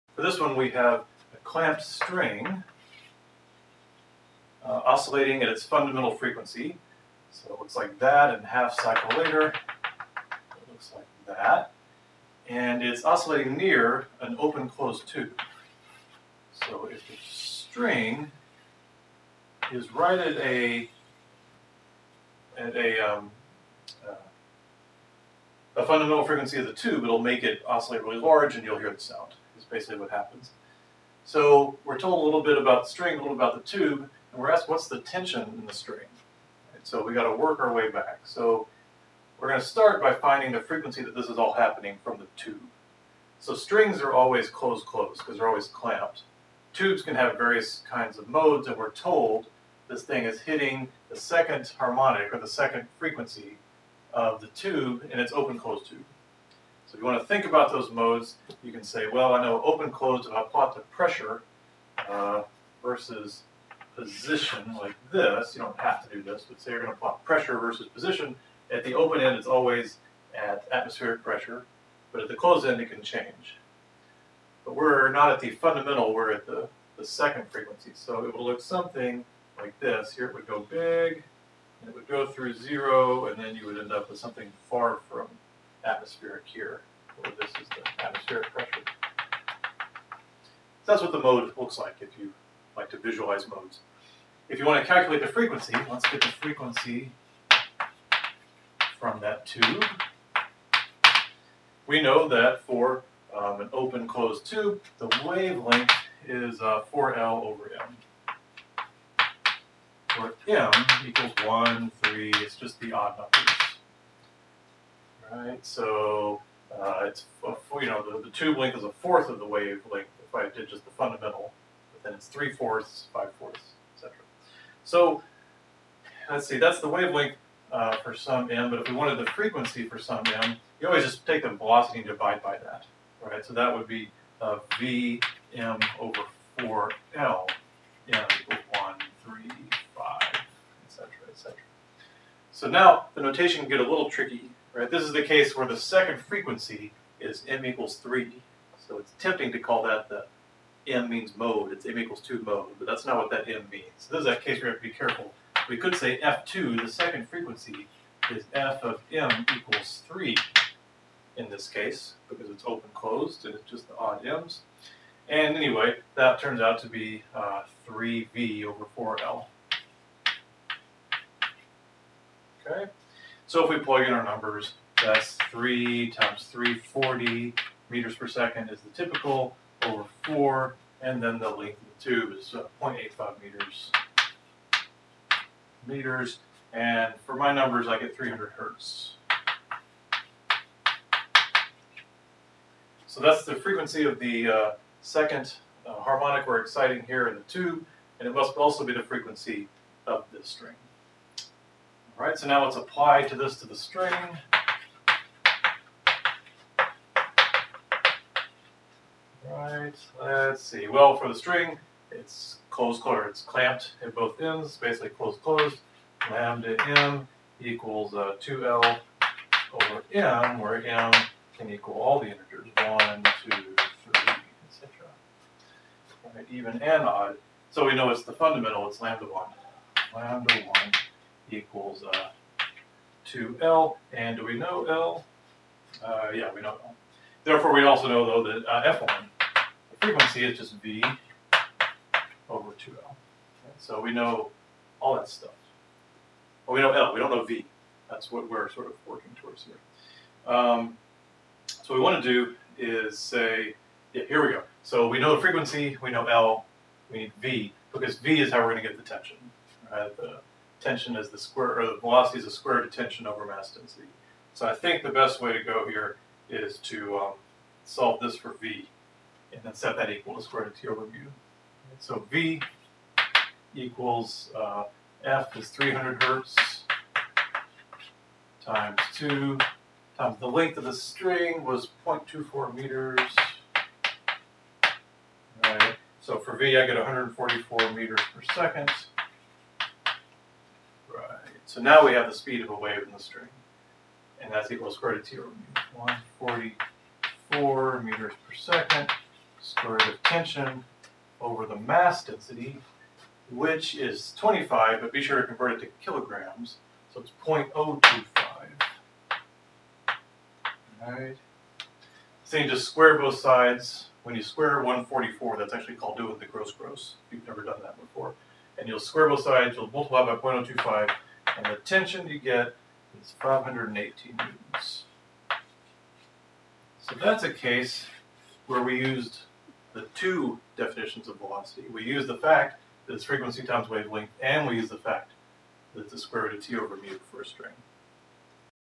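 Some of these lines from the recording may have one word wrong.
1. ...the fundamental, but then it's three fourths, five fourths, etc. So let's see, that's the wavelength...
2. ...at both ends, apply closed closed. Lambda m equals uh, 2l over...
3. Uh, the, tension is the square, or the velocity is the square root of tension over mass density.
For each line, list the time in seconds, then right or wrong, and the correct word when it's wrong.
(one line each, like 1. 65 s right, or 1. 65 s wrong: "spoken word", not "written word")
1. 120 s right
2. 214 s wrong: "basically", not "apply"
3. 260 s right.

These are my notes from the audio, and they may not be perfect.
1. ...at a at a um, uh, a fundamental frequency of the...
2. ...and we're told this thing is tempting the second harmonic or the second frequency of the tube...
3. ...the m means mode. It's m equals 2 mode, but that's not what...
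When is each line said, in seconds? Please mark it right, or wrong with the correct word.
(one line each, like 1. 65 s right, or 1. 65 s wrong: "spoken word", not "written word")
1. 20 s right
2. 48 s wrong: "hitting", not "tempting"
3. 150 s right.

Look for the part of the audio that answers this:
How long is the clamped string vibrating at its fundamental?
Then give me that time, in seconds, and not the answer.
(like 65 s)
282 s.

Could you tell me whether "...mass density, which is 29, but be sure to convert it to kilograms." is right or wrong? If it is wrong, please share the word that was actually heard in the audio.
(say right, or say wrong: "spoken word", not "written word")
wrong: "25", not "29".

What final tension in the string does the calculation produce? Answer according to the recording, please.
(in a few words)
518 newtons.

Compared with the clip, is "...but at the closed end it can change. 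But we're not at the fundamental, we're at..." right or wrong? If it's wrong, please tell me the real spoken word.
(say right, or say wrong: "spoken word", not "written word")
right.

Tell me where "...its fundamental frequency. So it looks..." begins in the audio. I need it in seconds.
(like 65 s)
5 s.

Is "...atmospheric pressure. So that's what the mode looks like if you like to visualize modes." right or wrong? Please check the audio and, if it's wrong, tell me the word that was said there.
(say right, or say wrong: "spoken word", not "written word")
right.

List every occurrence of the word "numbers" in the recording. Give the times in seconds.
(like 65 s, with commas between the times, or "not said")
113 s, 174 s, 187 s.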